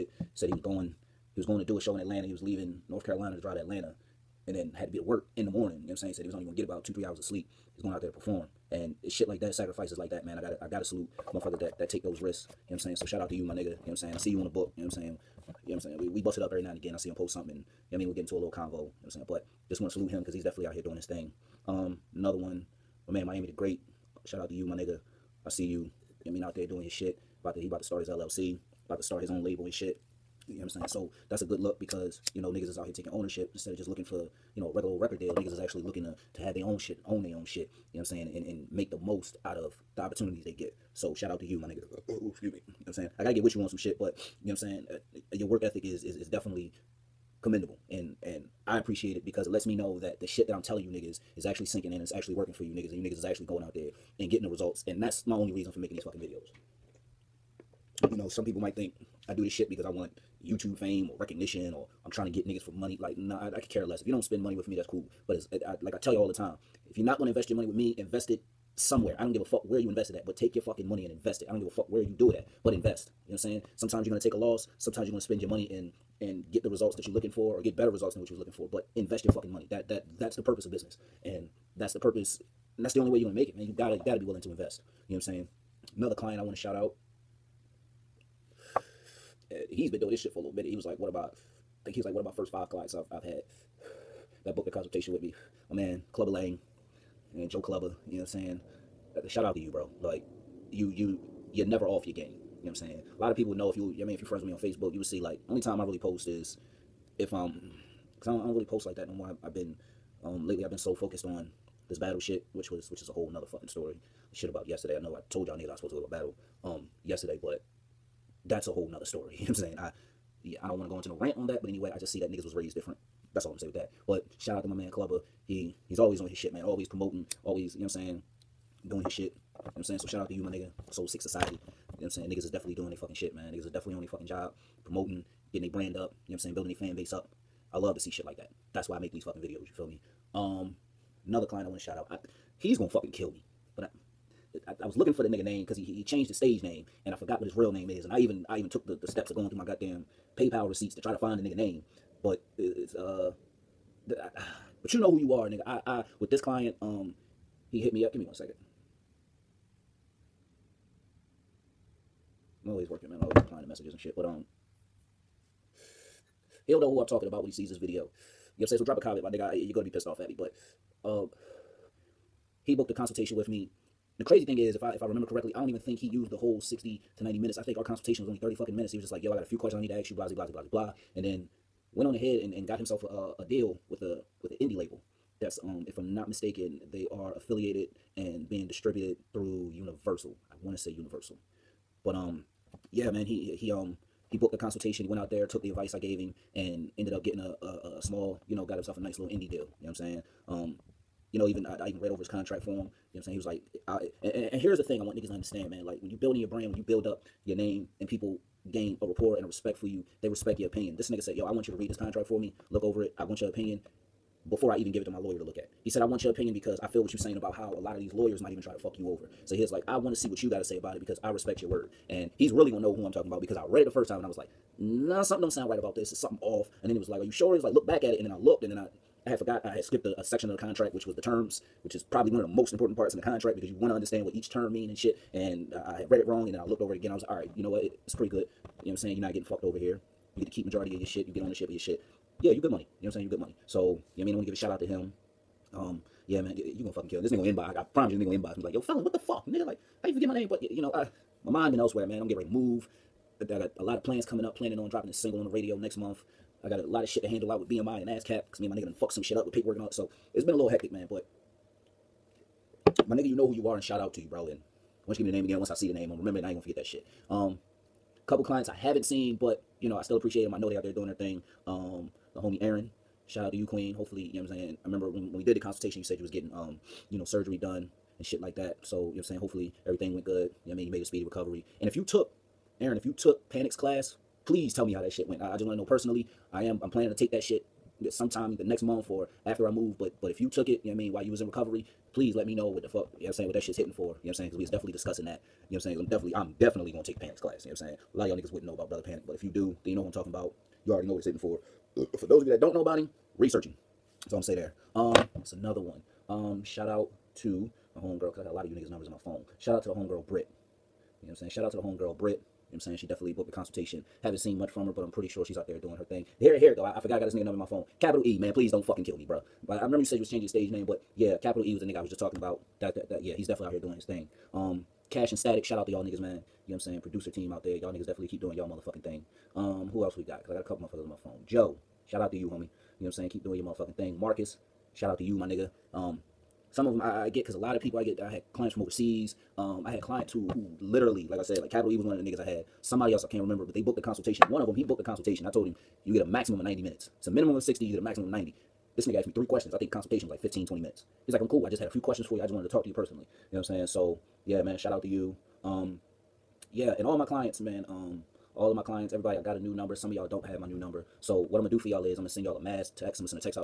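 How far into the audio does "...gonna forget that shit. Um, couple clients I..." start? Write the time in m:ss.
4:26.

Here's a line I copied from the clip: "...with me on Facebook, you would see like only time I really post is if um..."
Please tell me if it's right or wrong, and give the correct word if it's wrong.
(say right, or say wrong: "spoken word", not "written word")
right.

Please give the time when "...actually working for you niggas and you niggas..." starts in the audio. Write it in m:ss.
0:52.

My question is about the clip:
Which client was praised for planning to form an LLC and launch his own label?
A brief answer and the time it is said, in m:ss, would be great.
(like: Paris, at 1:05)
Miami the Great, at 0:23.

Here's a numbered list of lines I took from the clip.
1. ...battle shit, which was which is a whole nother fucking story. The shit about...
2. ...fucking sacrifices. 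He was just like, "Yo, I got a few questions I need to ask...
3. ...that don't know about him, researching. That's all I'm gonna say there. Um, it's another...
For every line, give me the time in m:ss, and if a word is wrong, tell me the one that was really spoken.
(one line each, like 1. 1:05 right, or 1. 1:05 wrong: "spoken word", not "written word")
1. 1:51 right
2. 2:58 wrong: "minutes", not "sacrifices"
3. 5:02 right.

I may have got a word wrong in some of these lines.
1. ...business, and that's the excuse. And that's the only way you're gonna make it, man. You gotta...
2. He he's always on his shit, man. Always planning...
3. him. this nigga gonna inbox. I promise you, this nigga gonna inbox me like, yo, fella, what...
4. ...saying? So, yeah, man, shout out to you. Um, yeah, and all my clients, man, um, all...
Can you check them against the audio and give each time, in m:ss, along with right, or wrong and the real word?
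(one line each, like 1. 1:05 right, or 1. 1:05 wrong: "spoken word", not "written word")
1. 1:20 wrong: "purpose", not "excuse"
2. 2:05 wrong: "promoting", not "planning"
3. 4:07 right
4. 5:53 right.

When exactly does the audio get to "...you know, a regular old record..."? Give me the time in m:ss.
0:34.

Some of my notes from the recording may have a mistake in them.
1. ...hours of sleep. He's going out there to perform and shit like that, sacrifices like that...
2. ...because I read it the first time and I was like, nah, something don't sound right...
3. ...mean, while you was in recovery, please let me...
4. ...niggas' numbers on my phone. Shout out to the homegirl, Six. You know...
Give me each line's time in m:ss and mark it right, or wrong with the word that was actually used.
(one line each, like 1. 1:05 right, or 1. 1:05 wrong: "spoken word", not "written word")
1. 0:07 right
2. 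3:43 right
3. 4:50 right
4. 5:08 wrong: "Britt", not "Six".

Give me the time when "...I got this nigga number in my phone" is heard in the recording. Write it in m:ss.
5:17.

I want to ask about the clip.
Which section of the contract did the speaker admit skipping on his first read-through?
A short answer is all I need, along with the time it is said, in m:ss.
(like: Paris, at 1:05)
The terms, at 3:51.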